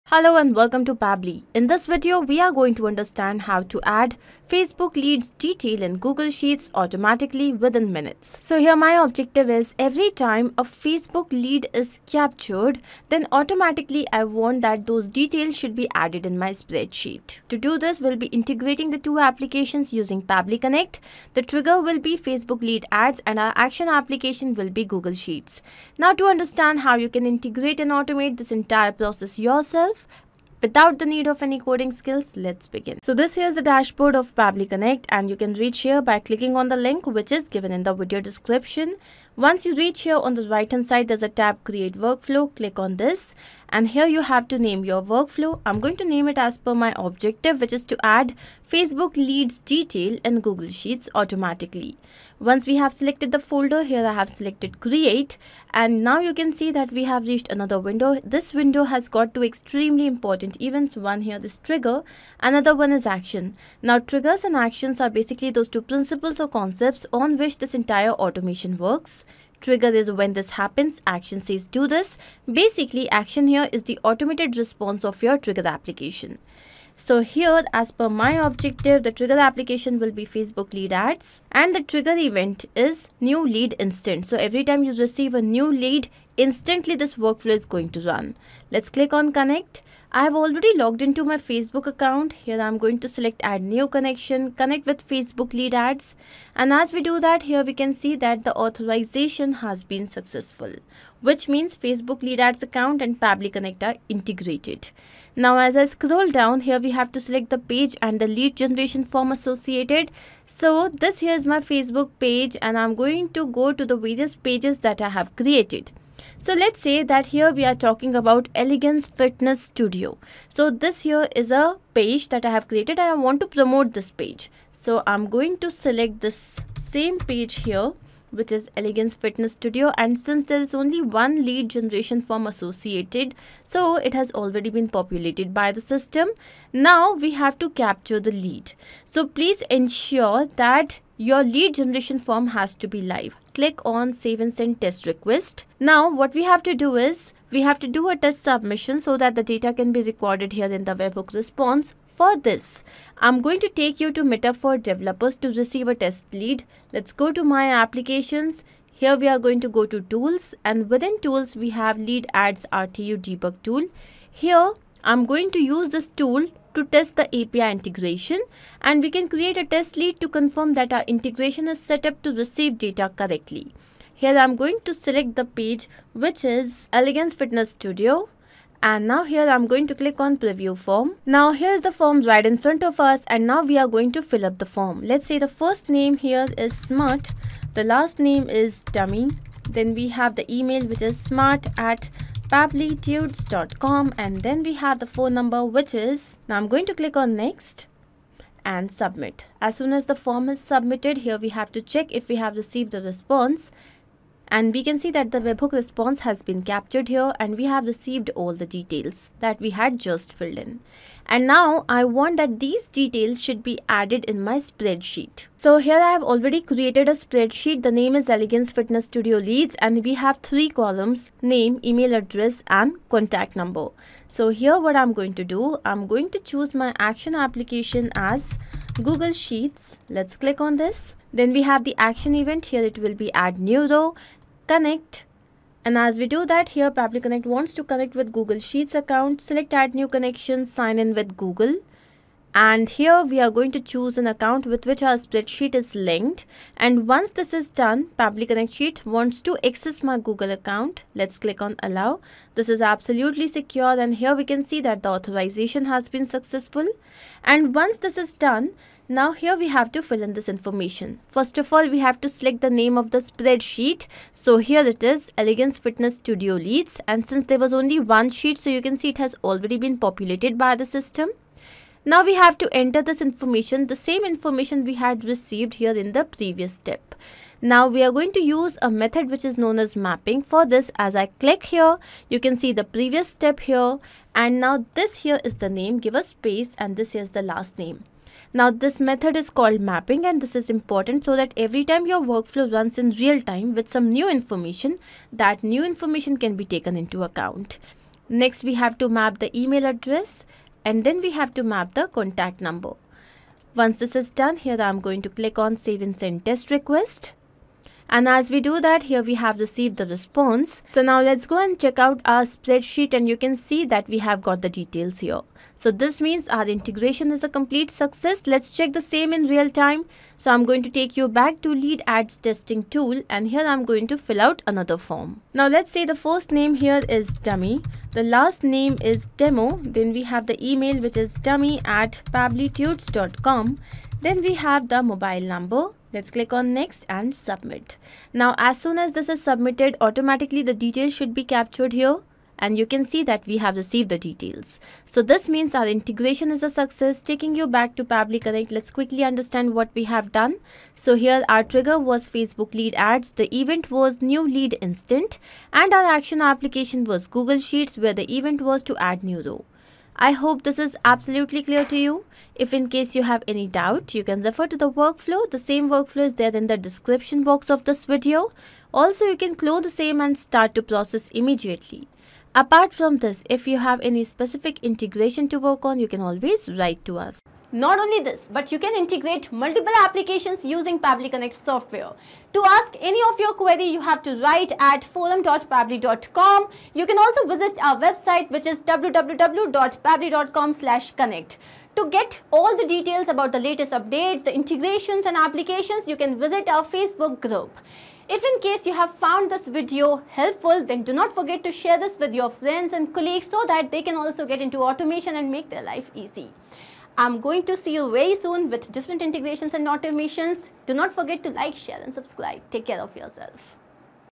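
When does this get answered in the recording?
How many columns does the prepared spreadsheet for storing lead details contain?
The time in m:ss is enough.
3:40.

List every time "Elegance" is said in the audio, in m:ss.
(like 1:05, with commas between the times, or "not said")
1:58, 2:08, 2:56, 3:38, 4:25.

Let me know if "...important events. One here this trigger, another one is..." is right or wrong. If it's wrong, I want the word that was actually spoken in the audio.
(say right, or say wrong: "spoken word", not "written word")
right.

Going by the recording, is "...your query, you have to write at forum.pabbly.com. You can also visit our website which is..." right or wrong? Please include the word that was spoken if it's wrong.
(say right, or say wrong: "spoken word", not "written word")
right.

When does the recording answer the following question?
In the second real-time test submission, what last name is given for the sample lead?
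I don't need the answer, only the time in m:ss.
5:29.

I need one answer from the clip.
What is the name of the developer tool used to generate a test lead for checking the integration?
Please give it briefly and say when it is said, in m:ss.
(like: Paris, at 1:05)
Lead ads RTU debug tool, at 2:41.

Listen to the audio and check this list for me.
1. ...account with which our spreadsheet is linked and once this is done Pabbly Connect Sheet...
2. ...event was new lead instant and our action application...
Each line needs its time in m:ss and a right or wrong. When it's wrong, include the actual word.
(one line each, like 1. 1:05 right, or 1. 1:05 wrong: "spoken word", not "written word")
1. 4:04 right
2. 5:53 right.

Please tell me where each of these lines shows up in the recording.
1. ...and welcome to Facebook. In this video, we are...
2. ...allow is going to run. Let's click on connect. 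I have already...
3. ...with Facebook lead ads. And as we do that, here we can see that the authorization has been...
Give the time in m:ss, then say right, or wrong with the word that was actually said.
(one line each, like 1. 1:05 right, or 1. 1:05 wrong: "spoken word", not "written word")
1. 0:00 wrong: "Pabbly", not "Facebook"
2. 1:27 wrong: "workflow", not "allow"
3. 1:34 right.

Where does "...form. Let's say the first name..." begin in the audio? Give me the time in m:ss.
3:04.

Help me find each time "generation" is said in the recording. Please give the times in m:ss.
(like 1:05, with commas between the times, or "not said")
1:48, 2:11, 2:21.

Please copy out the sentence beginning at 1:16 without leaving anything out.
So here, as per my objective, the trigger application will be Facebook lead ads and the trigger event is new lead instant.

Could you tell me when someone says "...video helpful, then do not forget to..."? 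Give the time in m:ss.
6:39.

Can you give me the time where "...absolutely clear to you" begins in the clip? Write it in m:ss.
6:01.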